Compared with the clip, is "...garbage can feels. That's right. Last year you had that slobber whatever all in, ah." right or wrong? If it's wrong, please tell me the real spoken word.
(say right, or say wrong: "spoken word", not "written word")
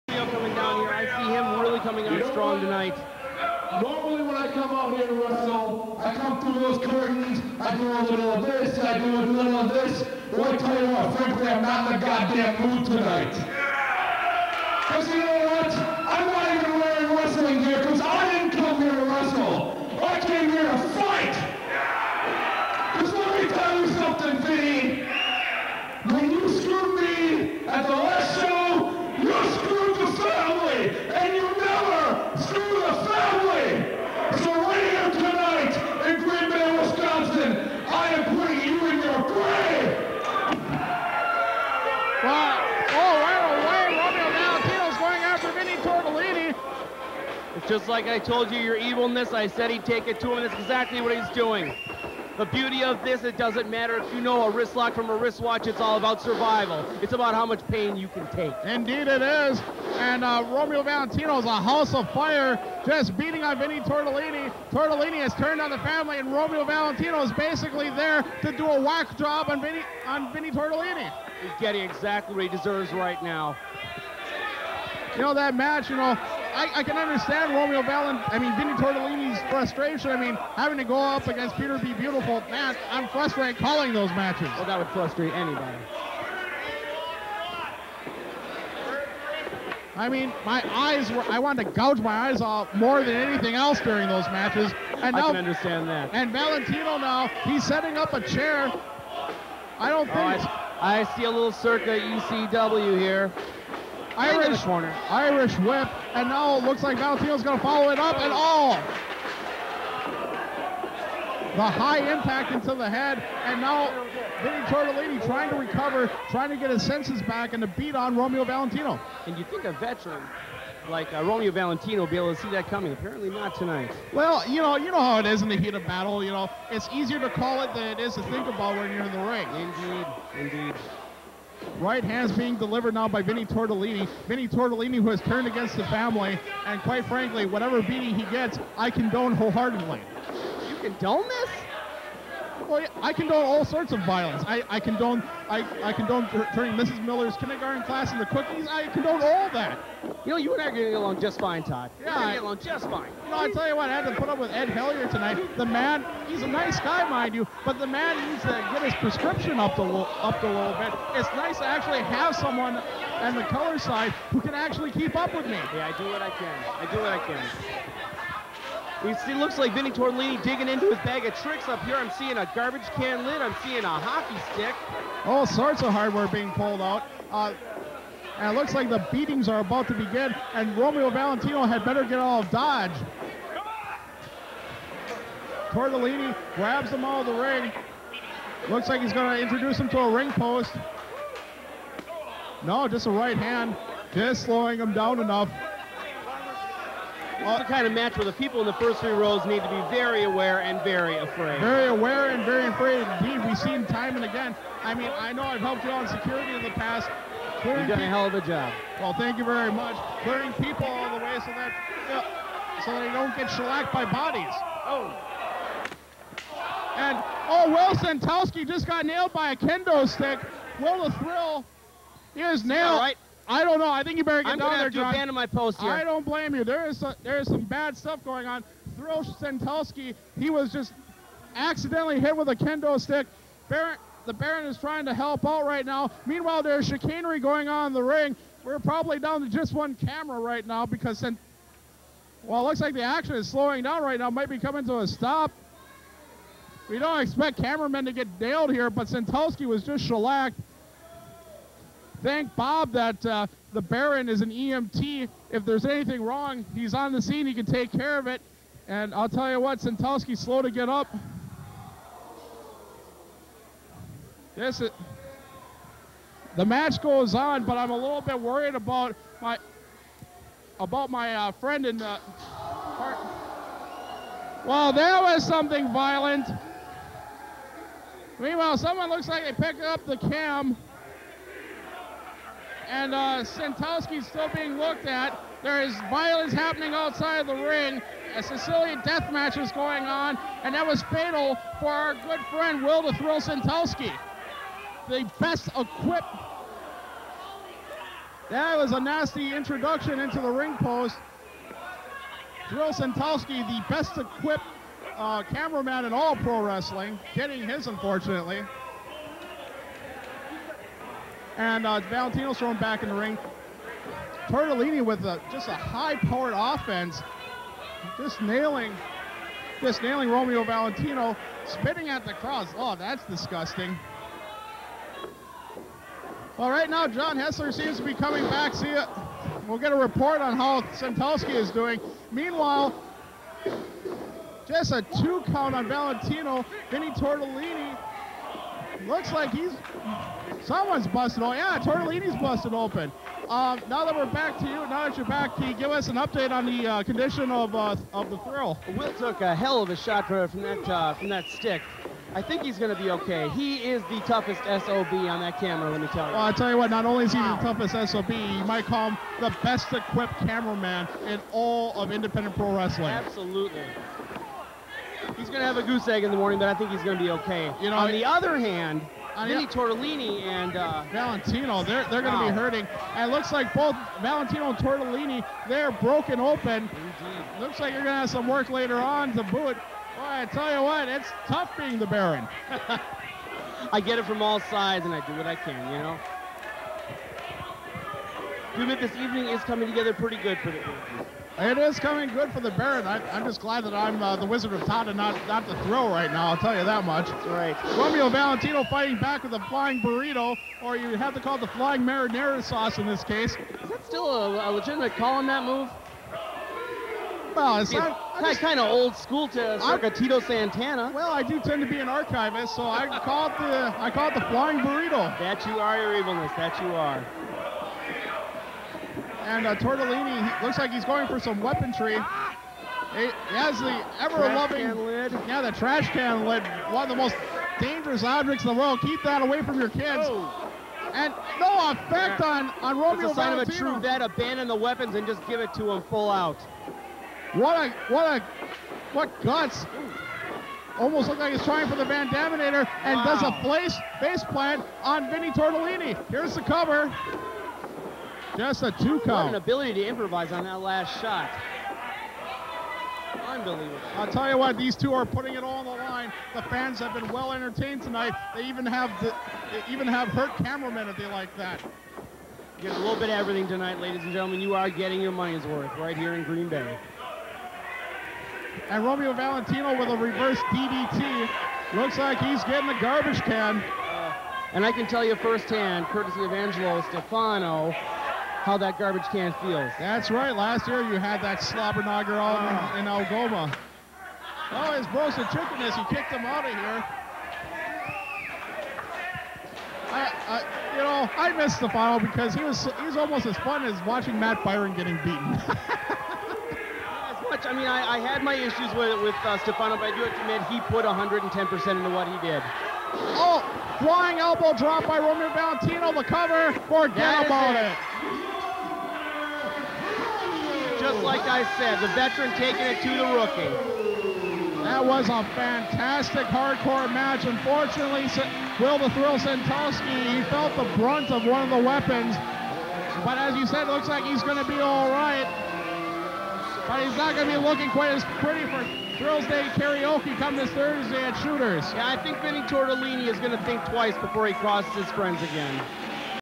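wrong: "knocker", not "whatever".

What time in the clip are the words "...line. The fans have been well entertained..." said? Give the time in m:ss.
7:36.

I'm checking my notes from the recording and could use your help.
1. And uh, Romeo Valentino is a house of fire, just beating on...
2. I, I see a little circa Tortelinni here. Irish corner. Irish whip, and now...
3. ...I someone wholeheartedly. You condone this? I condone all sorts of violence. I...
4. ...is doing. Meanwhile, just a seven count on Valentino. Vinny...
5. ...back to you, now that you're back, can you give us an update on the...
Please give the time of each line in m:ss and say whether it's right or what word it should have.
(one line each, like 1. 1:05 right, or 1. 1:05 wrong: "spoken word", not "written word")
1. 0:59 right
2. 1:40 wrong: "ECW", not "Tortelinni"
3. 2:18 wrong: "condone", not "someone"
4. 5:31 wrong: "two", not "seven"
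5. 5:44 right.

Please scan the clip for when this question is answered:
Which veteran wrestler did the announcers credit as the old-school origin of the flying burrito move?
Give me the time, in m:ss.
6:50.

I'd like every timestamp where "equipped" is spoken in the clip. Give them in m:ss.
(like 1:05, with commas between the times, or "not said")
4:55, 5:04, 5:59.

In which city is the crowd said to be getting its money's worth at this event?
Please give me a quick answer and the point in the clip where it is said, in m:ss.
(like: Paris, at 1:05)
Green Bay, at 7:46.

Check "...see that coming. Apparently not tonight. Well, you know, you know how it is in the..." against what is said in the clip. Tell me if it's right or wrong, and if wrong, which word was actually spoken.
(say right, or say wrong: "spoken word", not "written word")
right.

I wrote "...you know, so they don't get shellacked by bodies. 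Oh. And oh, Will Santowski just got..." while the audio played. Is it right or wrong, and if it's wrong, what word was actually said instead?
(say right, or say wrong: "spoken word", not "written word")
right.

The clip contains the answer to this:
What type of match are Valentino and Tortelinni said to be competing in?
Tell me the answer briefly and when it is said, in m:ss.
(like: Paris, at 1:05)
Sicilian death match, at 4:48.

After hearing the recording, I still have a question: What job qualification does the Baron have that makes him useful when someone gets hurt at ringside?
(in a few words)
EMT.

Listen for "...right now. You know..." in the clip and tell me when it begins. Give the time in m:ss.
1:12.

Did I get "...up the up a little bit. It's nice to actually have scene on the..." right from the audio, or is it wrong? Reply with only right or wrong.
wrong.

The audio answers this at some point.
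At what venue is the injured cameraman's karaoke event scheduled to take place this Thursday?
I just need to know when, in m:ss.
8:51.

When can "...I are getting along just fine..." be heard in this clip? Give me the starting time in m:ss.
2:30.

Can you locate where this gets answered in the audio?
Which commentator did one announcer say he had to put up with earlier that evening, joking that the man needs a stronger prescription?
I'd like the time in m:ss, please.
2:34.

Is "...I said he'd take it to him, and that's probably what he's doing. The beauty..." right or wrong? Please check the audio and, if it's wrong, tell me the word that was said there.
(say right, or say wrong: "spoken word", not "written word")
wrong: "exactly", not "probably".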